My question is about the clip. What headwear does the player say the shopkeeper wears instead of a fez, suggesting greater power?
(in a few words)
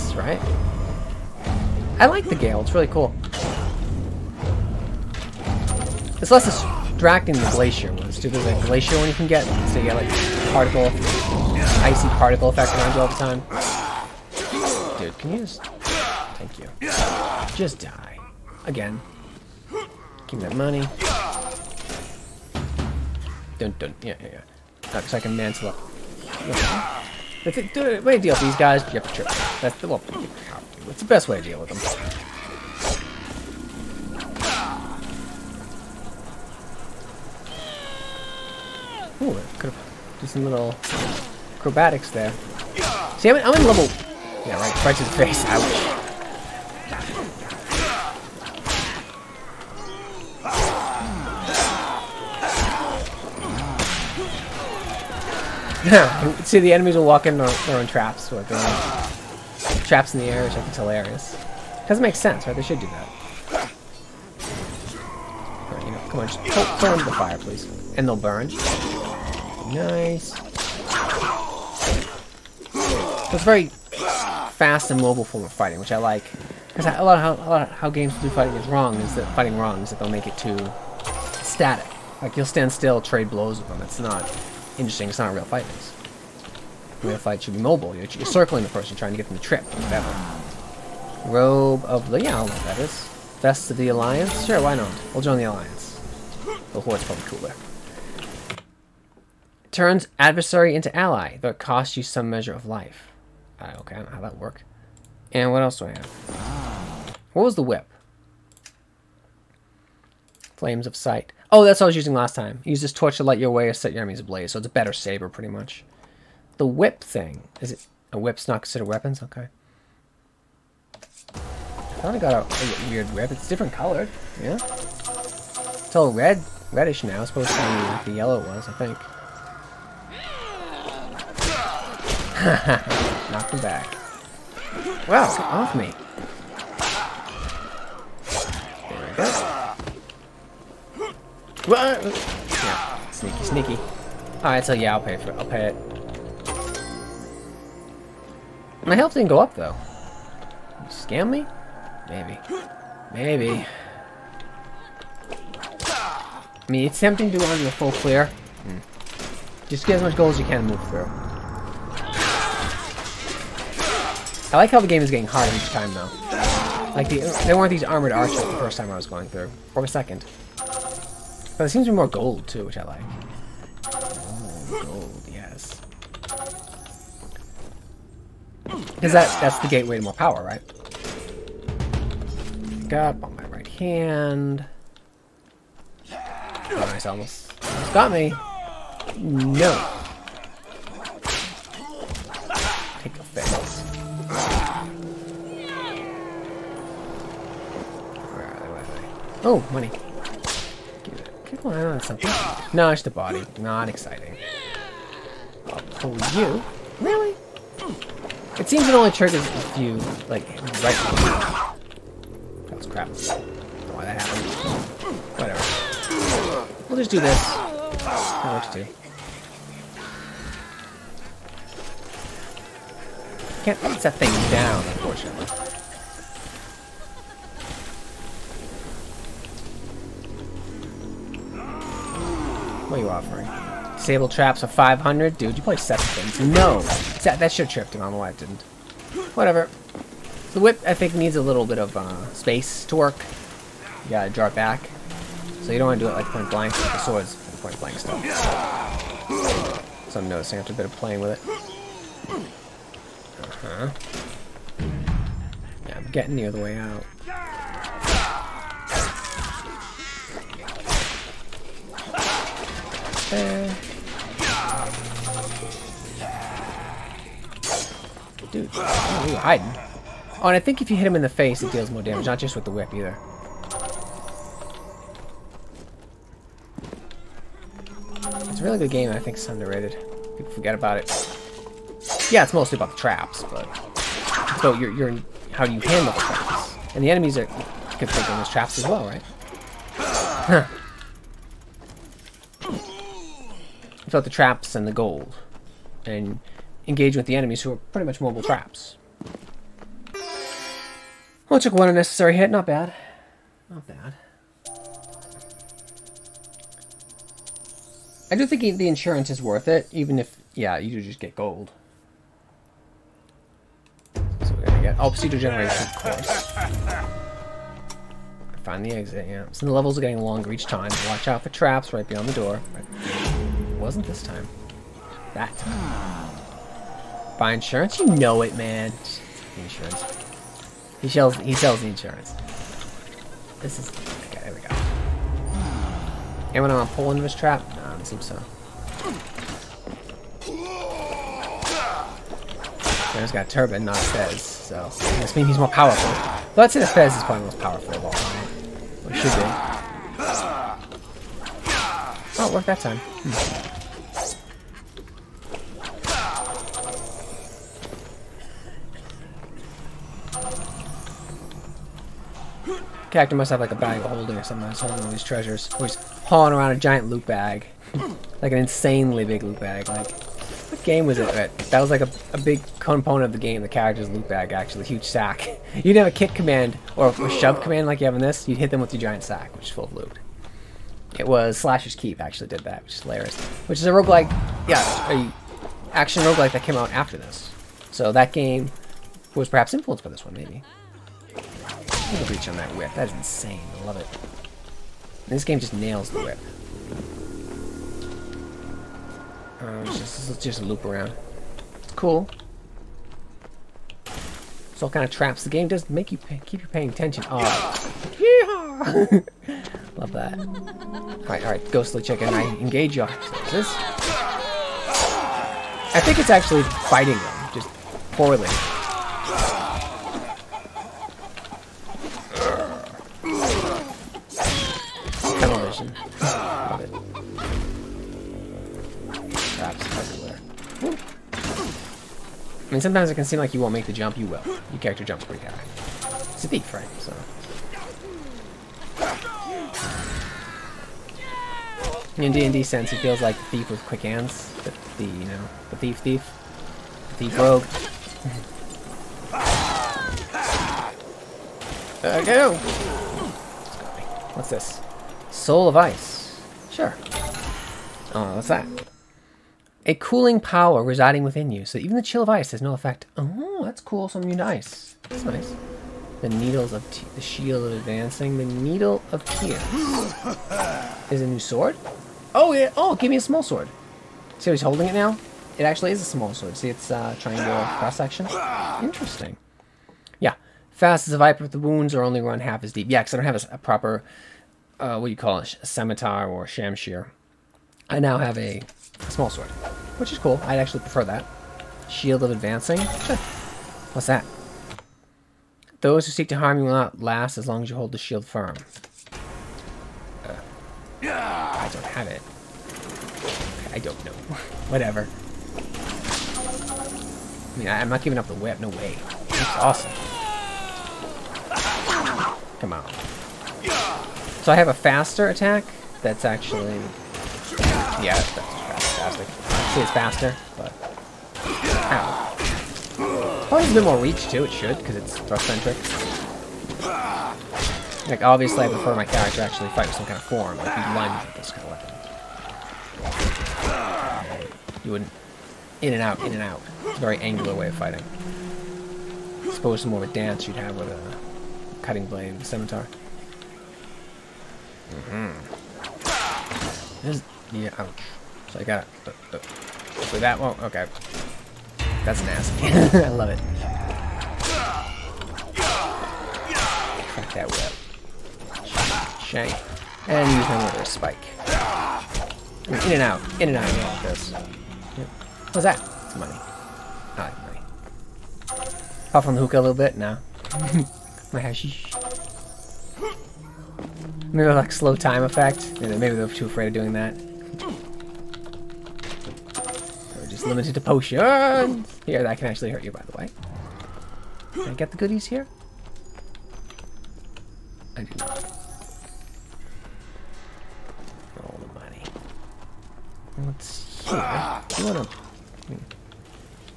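A turban.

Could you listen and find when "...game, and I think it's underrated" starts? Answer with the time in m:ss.
4:38.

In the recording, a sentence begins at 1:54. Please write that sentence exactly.
So it's a better saber, pretty much.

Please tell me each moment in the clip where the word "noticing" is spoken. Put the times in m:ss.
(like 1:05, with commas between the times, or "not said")
4:10.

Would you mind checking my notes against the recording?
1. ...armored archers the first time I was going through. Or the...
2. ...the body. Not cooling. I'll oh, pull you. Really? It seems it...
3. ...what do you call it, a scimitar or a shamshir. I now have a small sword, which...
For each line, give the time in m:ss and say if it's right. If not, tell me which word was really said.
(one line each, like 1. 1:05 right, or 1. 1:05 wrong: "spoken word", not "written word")
1. 2:47 right
2. 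3:23 wrong: "exciting", not "cooling"
3. 8:04 right.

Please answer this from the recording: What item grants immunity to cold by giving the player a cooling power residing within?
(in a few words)
Soul of Ice.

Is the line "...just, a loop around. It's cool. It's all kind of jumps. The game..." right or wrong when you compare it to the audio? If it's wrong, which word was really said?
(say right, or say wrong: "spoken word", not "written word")
wrong: "traps", not "jumps".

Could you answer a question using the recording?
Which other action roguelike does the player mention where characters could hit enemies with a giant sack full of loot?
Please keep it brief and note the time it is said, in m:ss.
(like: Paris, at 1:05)
Slasher's Keep, at 6:21.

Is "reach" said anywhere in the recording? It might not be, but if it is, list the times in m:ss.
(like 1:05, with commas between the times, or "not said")
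6:32, 8:43.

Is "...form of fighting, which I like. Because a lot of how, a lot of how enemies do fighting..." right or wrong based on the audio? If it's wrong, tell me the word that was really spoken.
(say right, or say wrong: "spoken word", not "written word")
wrong: "games", not "enemies".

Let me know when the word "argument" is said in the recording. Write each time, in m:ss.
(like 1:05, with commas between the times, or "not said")
not said.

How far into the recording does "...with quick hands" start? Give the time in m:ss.
7:23.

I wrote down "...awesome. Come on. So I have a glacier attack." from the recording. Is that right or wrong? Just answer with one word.
wrong.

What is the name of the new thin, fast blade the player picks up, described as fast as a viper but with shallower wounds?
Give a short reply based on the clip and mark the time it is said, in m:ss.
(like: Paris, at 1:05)
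The Needle of Tears, at 7:48.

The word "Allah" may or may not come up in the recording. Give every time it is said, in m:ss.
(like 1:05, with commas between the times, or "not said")
not said.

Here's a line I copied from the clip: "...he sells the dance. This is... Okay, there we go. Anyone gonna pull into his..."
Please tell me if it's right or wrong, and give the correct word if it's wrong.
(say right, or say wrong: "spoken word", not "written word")
wrong: "insurance", not "dance".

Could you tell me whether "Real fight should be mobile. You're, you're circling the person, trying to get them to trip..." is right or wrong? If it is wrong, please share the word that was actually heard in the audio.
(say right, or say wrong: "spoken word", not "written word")
right.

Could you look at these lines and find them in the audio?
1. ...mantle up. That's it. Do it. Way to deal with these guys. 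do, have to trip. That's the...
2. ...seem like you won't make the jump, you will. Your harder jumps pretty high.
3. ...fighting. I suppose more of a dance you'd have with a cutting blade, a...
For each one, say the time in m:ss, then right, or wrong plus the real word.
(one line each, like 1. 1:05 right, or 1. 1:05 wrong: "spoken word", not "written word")
1. 0:25 right
2. 7:13 wrong: "character", not "harder"
3. 8:57 right.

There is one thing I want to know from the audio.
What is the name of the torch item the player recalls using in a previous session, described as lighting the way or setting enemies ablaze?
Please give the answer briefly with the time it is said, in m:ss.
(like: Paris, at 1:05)
Flames of Sight, at 1:50.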